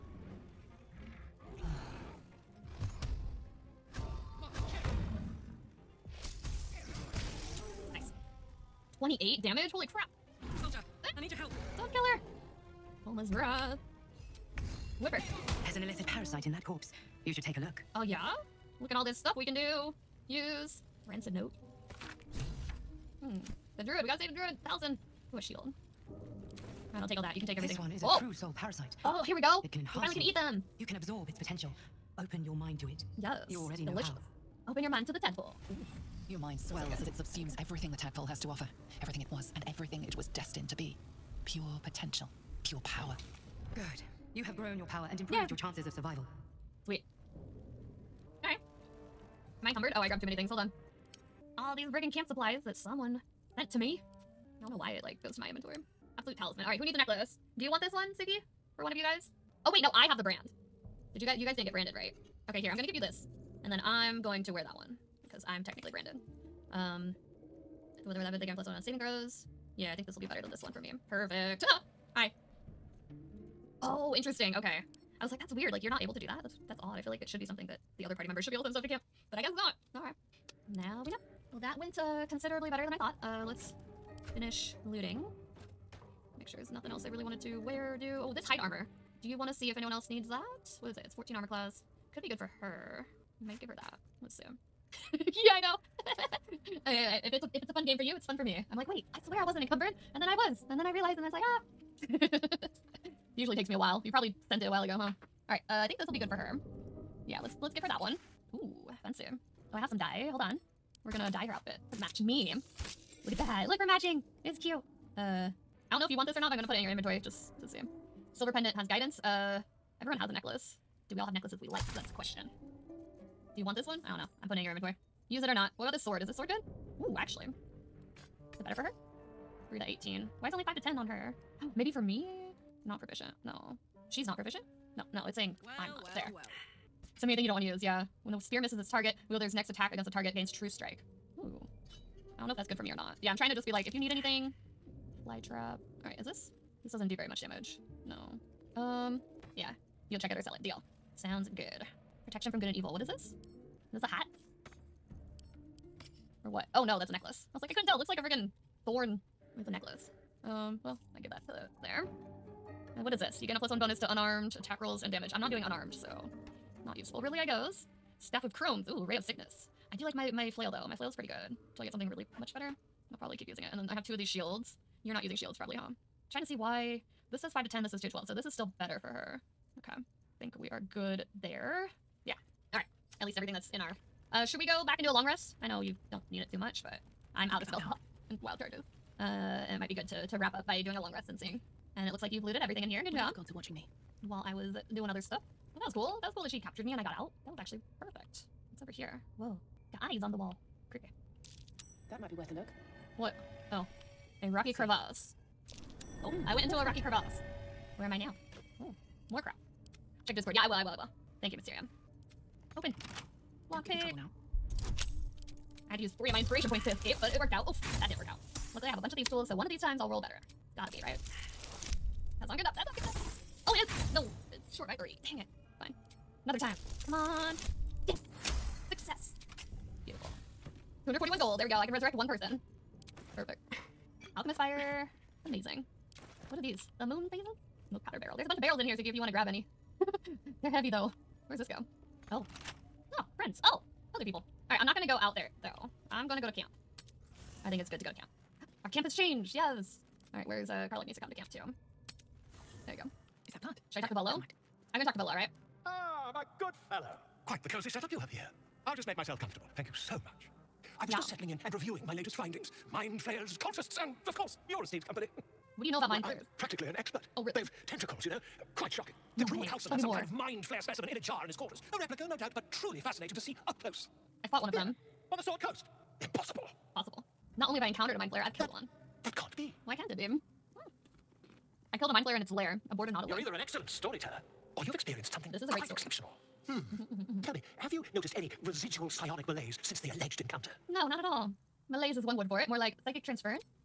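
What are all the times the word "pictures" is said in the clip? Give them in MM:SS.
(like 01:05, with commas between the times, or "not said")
01:26.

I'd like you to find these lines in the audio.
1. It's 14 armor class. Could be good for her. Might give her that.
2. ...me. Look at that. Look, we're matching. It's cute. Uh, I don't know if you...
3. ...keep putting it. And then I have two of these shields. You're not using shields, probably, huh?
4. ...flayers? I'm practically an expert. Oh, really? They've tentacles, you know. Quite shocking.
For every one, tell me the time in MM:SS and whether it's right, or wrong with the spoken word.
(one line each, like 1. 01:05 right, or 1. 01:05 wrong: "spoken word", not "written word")
1. 01:31 right
2. 01:52 right
3. 02:53 wrong: "using", not "putting"
4. 04:26 right.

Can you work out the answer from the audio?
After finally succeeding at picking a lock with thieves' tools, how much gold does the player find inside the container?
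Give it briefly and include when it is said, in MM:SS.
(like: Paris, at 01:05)
241, at 03:51.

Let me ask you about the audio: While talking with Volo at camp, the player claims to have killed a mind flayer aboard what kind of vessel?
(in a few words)
Nautilus.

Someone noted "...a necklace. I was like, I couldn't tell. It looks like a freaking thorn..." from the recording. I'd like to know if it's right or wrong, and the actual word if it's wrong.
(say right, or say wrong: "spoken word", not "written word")
right.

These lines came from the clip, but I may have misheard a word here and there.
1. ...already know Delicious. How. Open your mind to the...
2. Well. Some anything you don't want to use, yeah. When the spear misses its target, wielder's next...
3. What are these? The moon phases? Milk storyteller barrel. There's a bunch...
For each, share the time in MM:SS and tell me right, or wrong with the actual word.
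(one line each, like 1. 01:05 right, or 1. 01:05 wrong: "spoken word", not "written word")
1. 00:33 right
2. 02:16 right
3. 03:56 wrong: "powder", not "storyteller".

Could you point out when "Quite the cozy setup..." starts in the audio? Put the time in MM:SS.
04:17.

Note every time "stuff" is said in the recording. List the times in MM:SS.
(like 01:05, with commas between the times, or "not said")
00:19, 01:18, 03:15.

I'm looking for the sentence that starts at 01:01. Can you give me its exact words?
Did you guys, you guys didn't get branded, right?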